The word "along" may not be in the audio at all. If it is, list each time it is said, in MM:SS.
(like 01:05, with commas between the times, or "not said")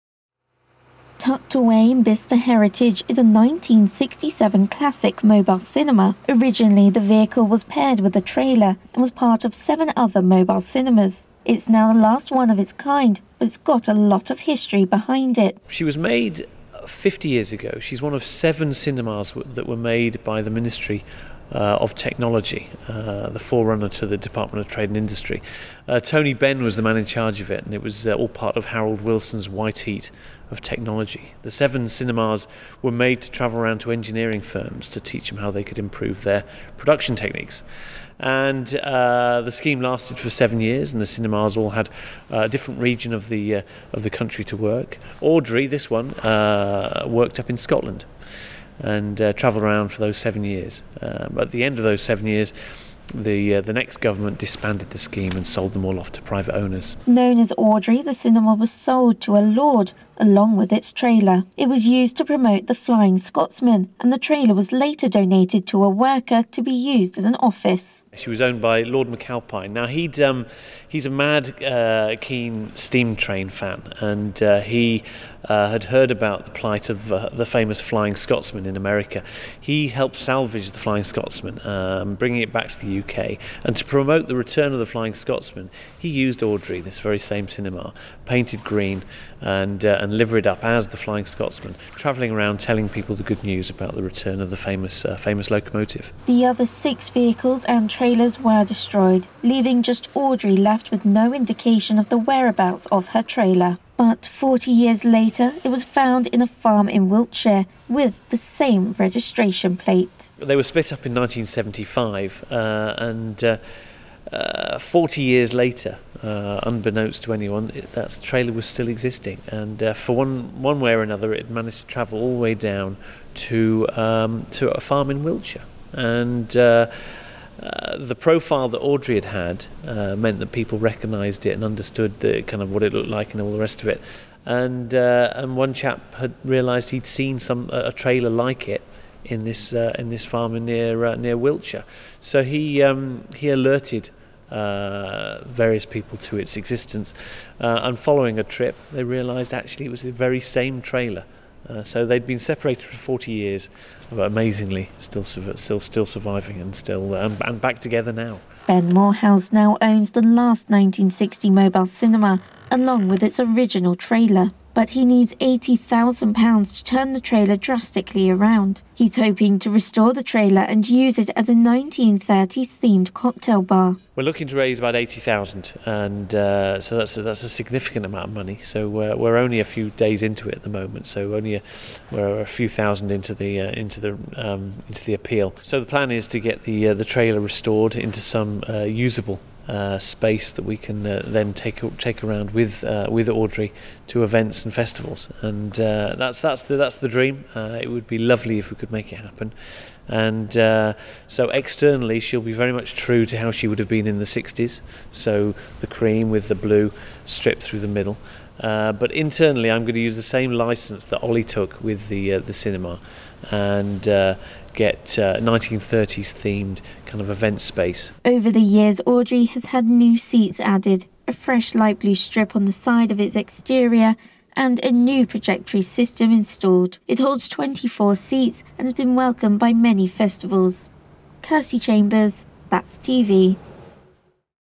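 01:00, 02:42.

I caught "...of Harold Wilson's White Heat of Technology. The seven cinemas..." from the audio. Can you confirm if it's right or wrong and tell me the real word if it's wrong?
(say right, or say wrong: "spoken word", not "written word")
right.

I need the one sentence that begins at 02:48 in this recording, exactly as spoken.
He's hoping to restore the trailer and use it as a 1930s themed cocktail bar.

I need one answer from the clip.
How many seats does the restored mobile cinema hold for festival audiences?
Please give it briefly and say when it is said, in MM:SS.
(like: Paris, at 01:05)
24, at 03:47.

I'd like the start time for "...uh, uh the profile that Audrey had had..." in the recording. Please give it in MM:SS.
02:06.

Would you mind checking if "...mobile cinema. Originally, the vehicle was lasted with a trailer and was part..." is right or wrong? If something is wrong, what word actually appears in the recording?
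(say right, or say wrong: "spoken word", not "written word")
wrong: "paired", not "lasted".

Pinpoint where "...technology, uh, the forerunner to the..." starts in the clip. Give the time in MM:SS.
00:21.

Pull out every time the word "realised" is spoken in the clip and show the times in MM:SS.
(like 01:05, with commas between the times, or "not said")
02:16, 02:29.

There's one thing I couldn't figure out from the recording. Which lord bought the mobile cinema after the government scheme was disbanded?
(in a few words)
Lord McAlpine.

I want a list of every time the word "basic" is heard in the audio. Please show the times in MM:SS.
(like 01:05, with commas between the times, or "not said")
not said.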